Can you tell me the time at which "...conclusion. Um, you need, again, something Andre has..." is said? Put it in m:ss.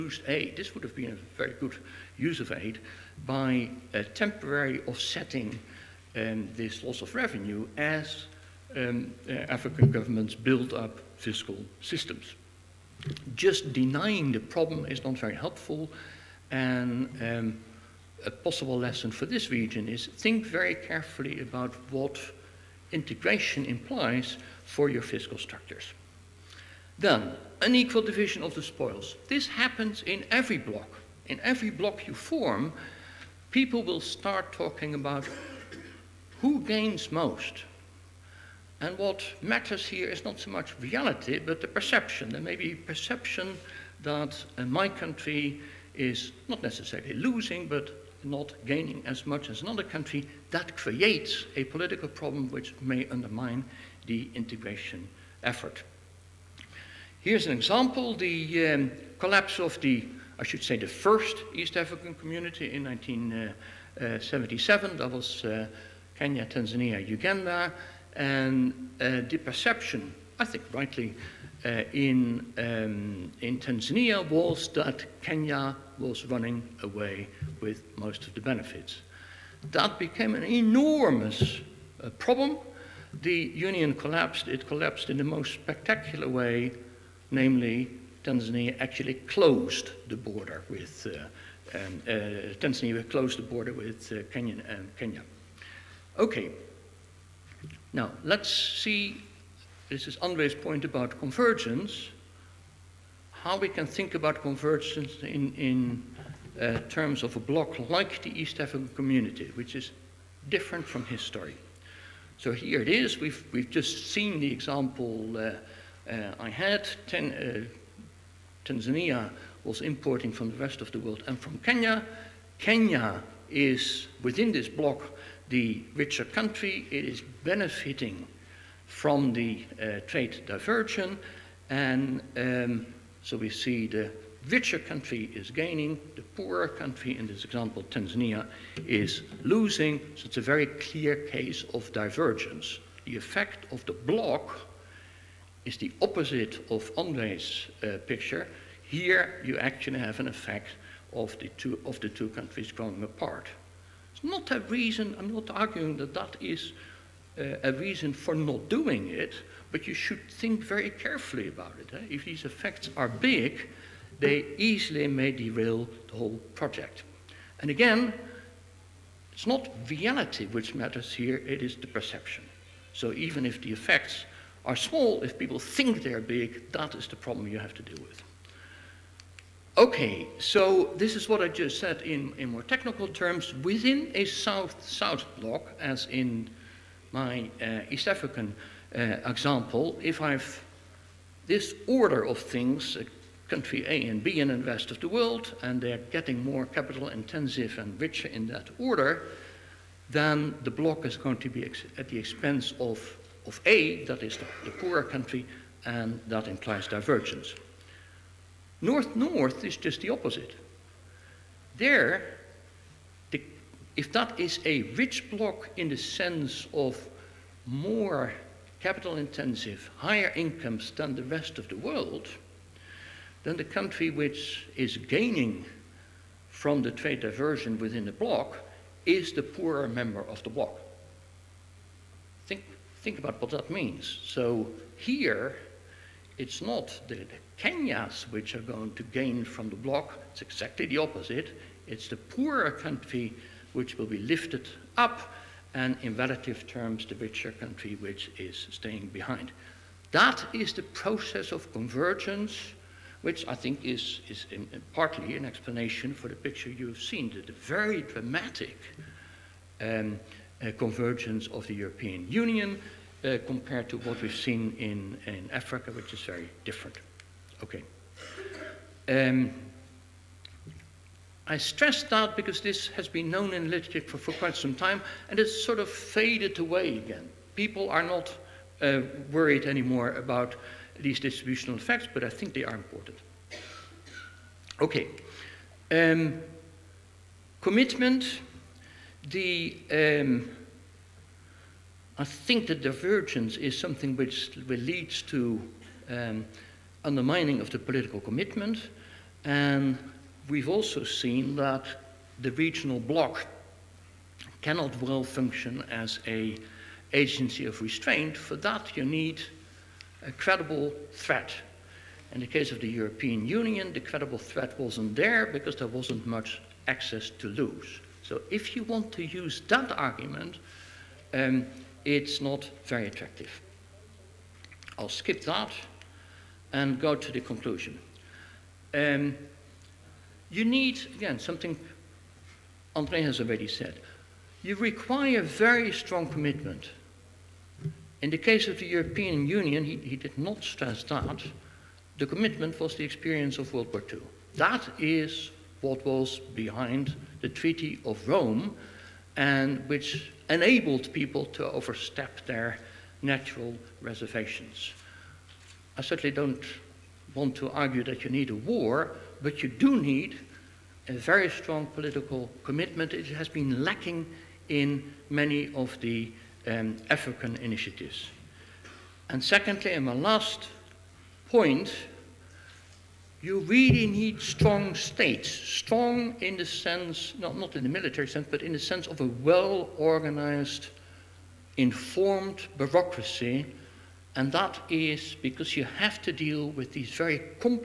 5:27.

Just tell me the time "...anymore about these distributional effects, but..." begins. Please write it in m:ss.
4:39.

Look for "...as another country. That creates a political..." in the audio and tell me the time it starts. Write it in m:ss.
0:49.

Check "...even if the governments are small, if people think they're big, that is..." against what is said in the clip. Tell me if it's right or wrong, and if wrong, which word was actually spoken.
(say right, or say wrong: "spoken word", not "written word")
wrong: "effects", not "governments".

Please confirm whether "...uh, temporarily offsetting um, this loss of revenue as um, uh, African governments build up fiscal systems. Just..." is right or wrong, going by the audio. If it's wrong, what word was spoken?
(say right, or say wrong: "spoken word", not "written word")
right.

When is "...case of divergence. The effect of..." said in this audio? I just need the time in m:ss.
2:21.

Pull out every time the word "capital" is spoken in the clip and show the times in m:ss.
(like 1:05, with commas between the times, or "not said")
3:16, 3:38.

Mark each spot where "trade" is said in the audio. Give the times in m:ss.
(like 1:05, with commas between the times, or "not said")
2:10, 3:46.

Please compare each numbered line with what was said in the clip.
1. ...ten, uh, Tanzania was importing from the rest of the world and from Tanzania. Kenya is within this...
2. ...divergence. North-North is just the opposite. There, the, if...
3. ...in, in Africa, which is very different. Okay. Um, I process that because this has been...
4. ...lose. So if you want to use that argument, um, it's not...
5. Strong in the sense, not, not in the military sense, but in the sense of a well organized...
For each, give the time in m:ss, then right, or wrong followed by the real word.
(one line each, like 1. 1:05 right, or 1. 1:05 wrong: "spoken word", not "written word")
1. 1:57 wrong: "Kenya", not "Tanzania"
2. 3:26 right
3. 4:24 wrong: "stress", not "process"
4. 5:17 right
5. 6:15 right.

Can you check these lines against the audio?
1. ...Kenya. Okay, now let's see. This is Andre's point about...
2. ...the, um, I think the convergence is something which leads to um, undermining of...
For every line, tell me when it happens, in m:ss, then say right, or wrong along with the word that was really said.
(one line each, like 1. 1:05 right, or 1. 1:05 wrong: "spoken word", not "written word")
1. 1:34 right
2. 4:49 wrong: "divergence", not "convergence".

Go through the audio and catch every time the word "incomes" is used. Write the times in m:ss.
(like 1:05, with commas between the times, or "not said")
3:40.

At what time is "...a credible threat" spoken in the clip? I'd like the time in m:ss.
5:10.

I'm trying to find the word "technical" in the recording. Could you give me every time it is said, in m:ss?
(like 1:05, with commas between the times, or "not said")
3:02.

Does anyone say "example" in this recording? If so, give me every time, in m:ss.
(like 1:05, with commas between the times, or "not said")
0:57, 1:54, 2:17, 3:09.